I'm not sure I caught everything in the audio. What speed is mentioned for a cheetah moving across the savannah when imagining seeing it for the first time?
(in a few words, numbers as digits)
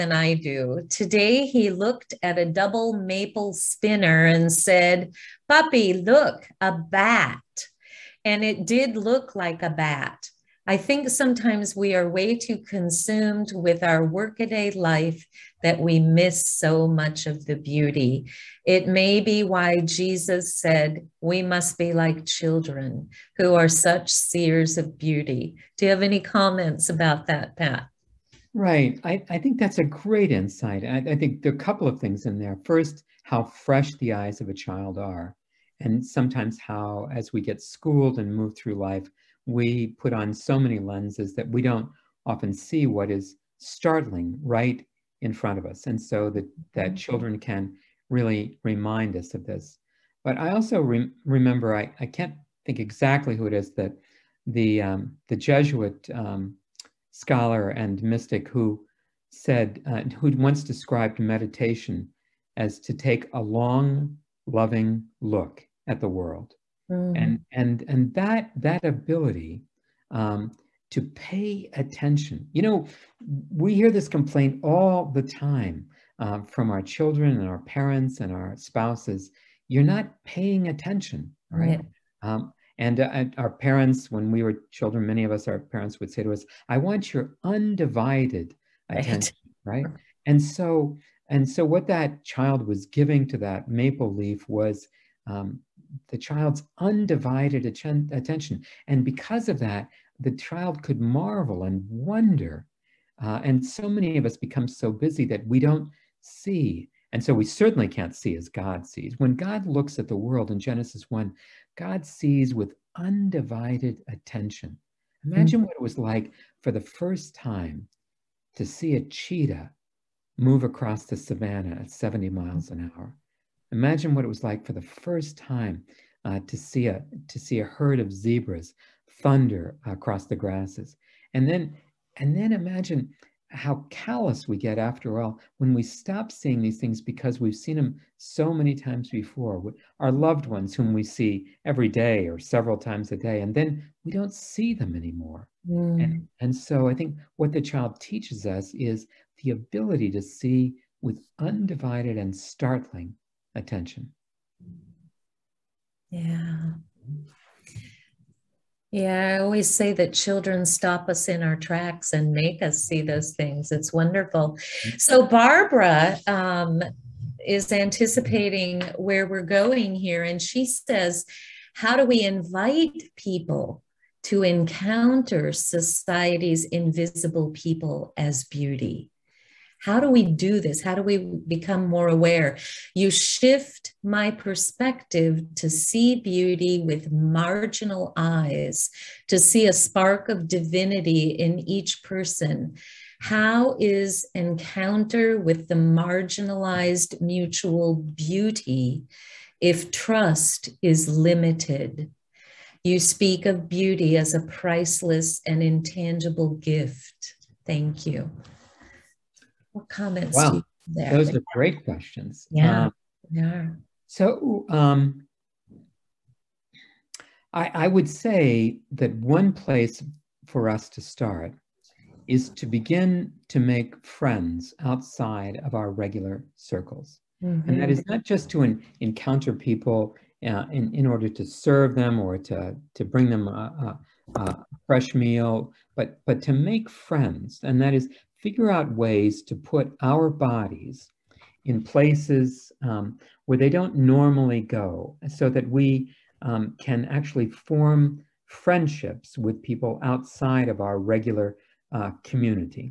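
70 miles an hour.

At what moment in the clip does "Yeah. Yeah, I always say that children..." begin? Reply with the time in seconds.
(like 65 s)
156 s.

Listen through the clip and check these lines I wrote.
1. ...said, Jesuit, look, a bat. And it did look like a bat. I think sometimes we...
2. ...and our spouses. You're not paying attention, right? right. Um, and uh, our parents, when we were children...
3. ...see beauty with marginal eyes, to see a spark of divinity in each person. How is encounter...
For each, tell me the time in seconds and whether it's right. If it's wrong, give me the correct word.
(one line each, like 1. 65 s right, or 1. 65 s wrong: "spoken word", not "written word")
1. 4 s wrong: "Puppy", not "Jesuit"
2. 78 s right
3. 185 s right.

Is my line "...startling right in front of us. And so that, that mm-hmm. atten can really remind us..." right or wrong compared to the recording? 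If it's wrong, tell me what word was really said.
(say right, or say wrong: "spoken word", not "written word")
wrong: "children", not "atten".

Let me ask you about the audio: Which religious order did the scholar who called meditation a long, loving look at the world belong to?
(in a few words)
Jesuit.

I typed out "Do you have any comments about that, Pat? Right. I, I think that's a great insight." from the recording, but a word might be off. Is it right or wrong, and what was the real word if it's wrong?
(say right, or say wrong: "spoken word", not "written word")
right.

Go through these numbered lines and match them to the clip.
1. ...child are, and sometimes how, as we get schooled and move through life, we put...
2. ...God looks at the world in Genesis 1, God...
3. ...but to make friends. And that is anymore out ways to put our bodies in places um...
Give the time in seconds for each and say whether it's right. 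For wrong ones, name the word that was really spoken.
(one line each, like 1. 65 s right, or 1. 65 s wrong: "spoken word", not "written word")
1. 34 s right
2. 109 s right
3. 236 s wrong: "figure", not "anymore".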